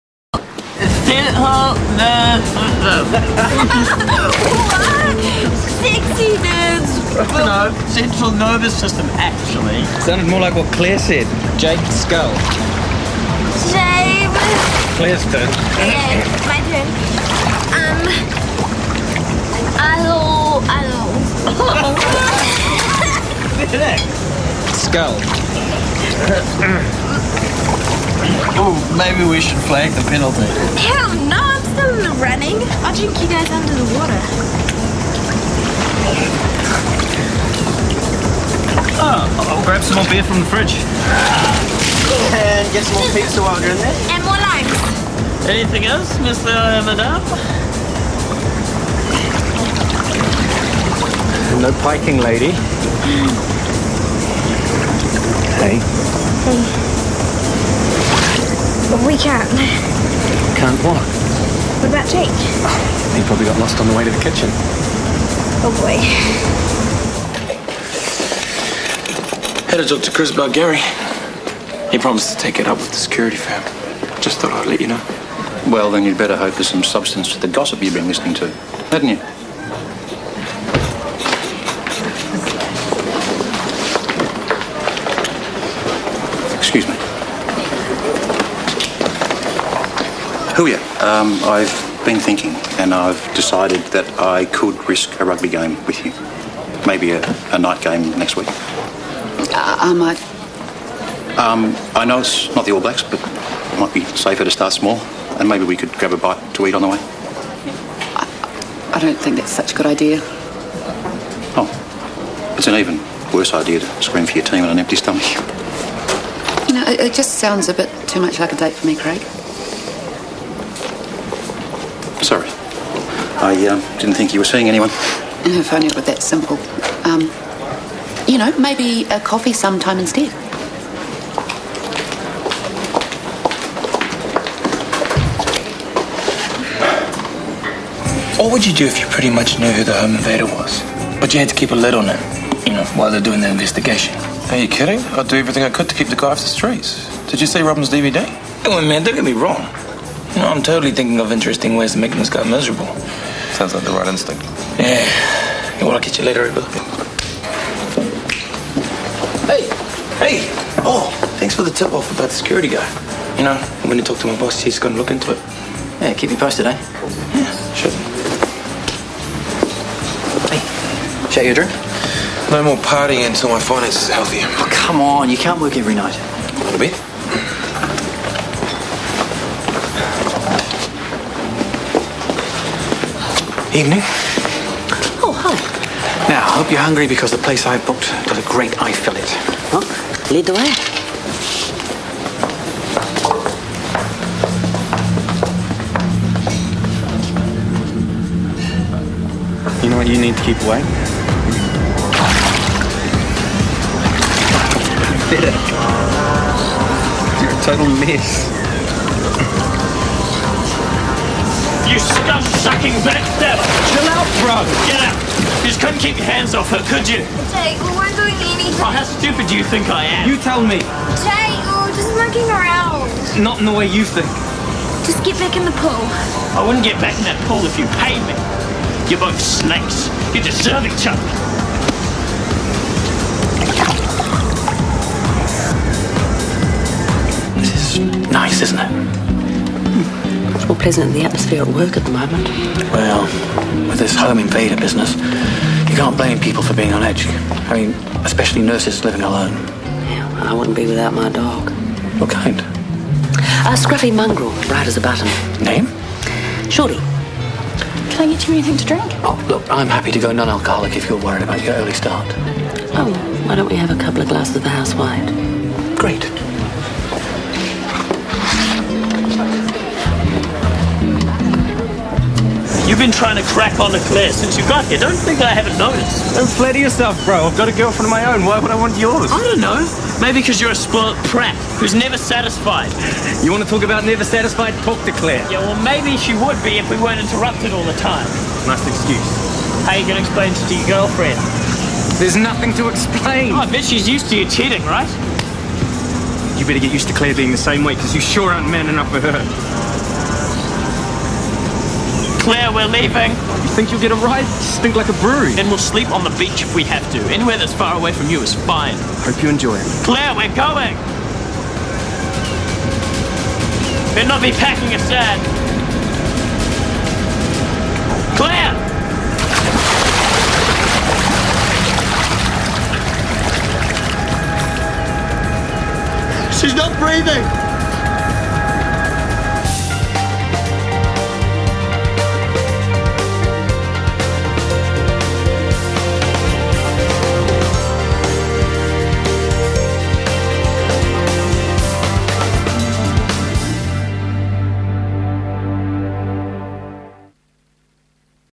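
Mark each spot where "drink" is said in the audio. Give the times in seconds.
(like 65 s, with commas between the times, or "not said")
32 s, 171 s, 258 s.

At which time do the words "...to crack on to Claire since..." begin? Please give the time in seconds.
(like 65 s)
273 s.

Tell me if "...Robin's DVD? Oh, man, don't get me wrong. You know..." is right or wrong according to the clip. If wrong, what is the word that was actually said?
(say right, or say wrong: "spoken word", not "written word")
right.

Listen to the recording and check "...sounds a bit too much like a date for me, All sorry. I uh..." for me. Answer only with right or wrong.
wrong.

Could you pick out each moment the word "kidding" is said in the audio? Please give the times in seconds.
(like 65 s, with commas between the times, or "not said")
144 s.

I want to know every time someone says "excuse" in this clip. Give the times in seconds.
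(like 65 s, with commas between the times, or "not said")
288 s.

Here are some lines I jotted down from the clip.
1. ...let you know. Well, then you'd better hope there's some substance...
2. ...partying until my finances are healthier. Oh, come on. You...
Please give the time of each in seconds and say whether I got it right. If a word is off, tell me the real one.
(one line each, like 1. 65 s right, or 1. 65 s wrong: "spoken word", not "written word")
1. 74 s right
2. 172 s right.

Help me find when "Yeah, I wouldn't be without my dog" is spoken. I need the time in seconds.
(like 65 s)
250 s.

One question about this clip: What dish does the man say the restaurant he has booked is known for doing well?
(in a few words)
Eye fillet.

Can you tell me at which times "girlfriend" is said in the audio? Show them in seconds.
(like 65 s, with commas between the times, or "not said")
277 s, 290 s.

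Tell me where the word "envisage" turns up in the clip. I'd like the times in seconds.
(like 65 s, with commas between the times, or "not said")
not said.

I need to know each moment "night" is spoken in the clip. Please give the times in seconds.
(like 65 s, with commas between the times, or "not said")
97 s, 175 s.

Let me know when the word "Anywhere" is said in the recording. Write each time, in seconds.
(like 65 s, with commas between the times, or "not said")
307 s.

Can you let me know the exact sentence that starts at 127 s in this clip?
Um, you know, maybe a coffee sometime instead.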